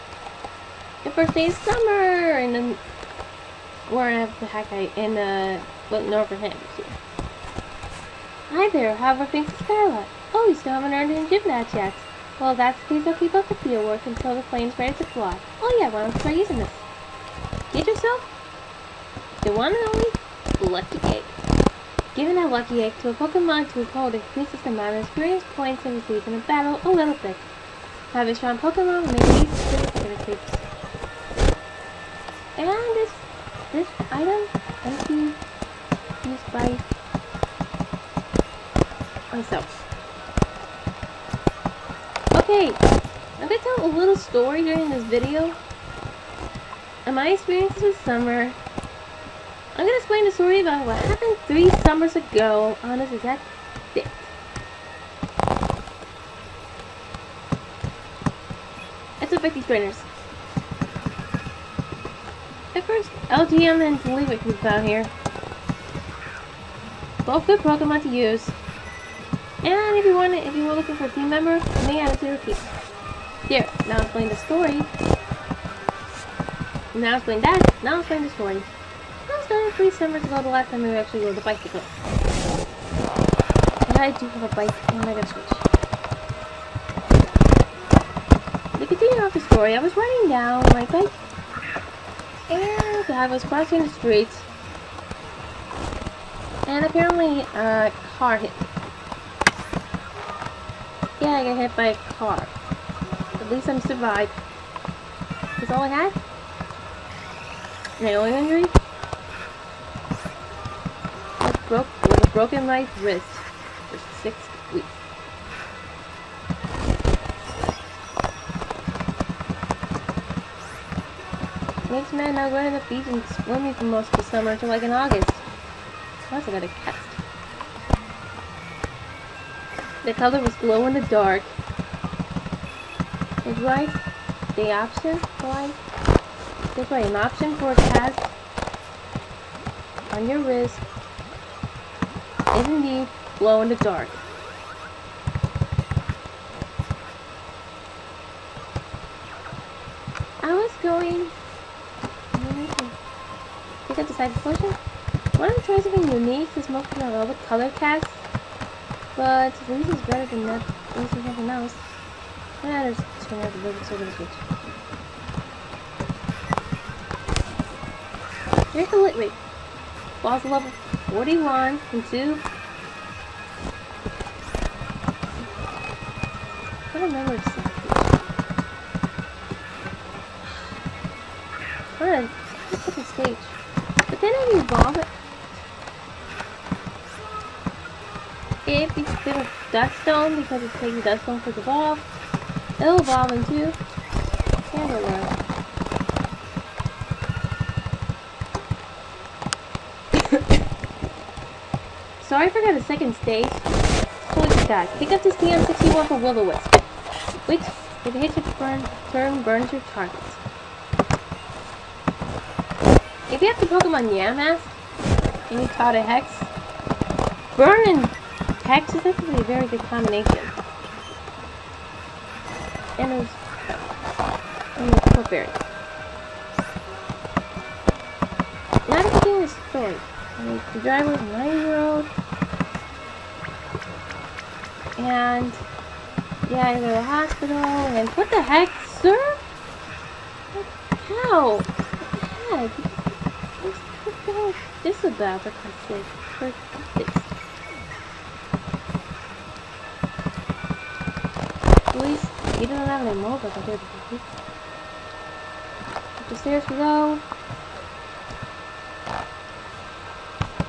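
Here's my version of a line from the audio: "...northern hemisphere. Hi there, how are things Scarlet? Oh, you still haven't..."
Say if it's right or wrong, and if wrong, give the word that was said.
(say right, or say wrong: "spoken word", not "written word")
right.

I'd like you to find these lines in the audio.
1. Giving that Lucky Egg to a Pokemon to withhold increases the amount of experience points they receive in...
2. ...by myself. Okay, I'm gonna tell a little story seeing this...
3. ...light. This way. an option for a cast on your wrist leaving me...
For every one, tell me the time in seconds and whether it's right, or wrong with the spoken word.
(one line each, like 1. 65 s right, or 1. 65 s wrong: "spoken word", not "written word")
1. 22 s right
2. 36 s wrong: "during", not "seeing"
3. 135 s right.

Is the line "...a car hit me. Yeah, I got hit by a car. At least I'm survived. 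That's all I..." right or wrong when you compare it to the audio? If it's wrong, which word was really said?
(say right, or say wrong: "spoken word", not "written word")
right.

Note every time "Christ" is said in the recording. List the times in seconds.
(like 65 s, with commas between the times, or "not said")
245 s, 251 s.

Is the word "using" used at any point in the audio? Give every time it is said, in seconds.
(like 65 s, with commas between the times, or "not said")
16 s.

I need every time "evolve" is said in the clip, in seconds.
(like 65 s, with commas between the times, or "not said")
184 s, 193 s.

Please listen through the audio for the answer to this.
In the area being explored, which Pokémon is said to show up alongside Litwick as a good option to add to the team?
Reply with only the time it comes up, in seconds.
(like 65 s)
63 s.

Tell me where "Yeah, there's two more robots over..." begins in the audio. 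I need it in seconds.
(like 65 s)
162 s.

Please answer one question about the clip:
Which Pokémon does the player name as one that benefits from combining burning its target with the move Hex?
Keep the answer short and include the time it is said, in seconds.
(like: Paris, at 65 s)
Yamask, at 214 s.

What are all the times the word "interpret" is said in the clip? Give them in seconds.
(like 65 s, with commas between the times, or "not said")
not said.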